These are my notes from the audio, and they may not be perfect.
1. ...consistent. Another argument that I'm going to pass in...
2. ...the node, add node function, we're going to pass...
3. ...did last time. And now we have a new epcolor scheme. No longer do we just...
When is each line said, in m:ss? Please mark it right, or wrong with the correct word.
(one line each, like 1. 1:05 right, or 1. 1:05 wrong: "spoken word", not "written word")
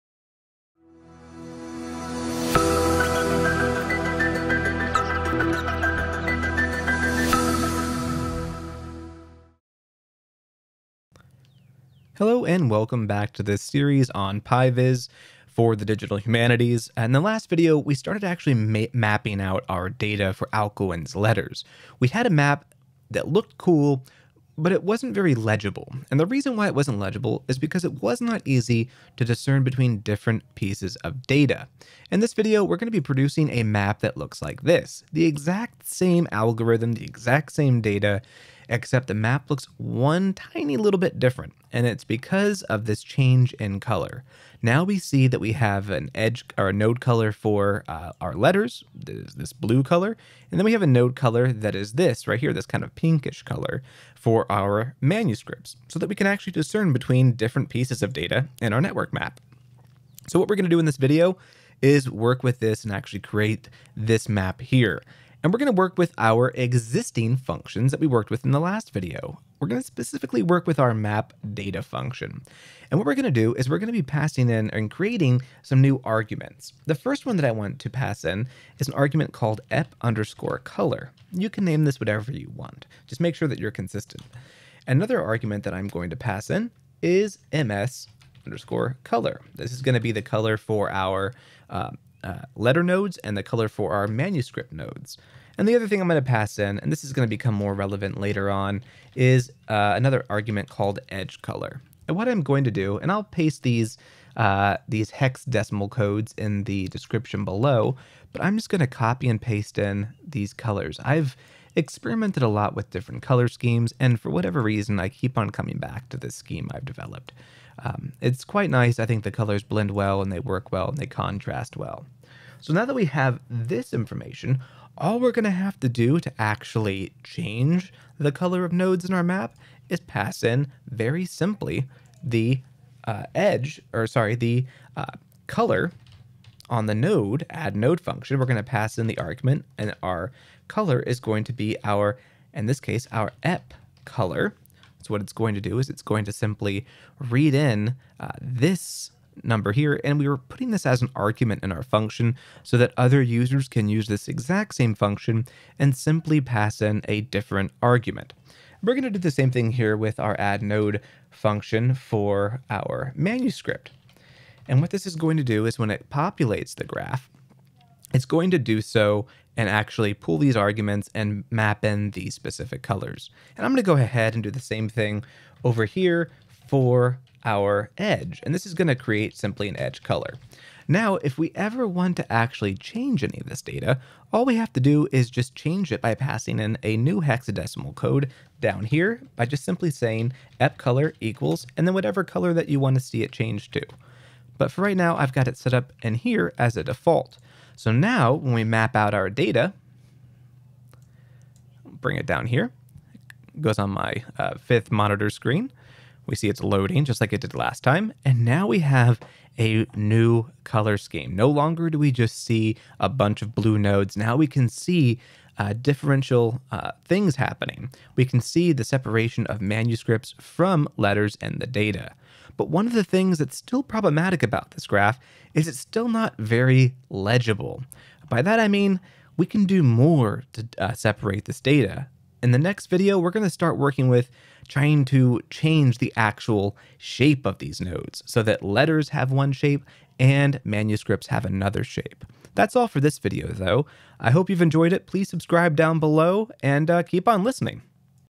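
1. 1:23 right
2. 2:16 right
3. 3:27 wrong: "color", not "epcolor".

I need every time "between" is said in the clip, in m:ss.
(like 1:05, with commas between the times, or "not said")
0:29, 0:56.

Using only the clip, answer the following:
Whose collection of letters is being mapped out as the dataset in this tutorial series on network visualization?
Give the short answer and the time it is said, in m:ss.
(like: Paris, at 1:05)
Alcuin, at 0:20.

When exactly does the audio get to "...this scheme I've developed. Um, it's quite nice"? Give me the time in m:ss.
1:56.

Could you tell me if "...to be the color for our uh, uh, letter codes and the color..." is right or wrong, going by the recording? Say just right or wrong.
wrong.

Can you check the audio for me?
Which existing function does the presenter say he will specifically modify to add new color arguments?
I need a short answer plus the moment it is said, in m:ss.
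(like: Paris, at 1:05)
map data, at 1:10.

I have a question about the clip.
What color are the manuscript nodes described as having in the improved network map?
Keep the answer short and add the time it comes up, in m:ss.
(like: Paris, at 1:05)
pinkish, at 0:52.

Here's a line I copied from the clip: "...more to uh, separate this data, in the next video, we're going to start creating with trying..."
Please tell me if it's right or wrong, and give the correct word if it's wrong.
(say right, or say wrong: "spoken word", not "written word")
wrong: "working", not "creating".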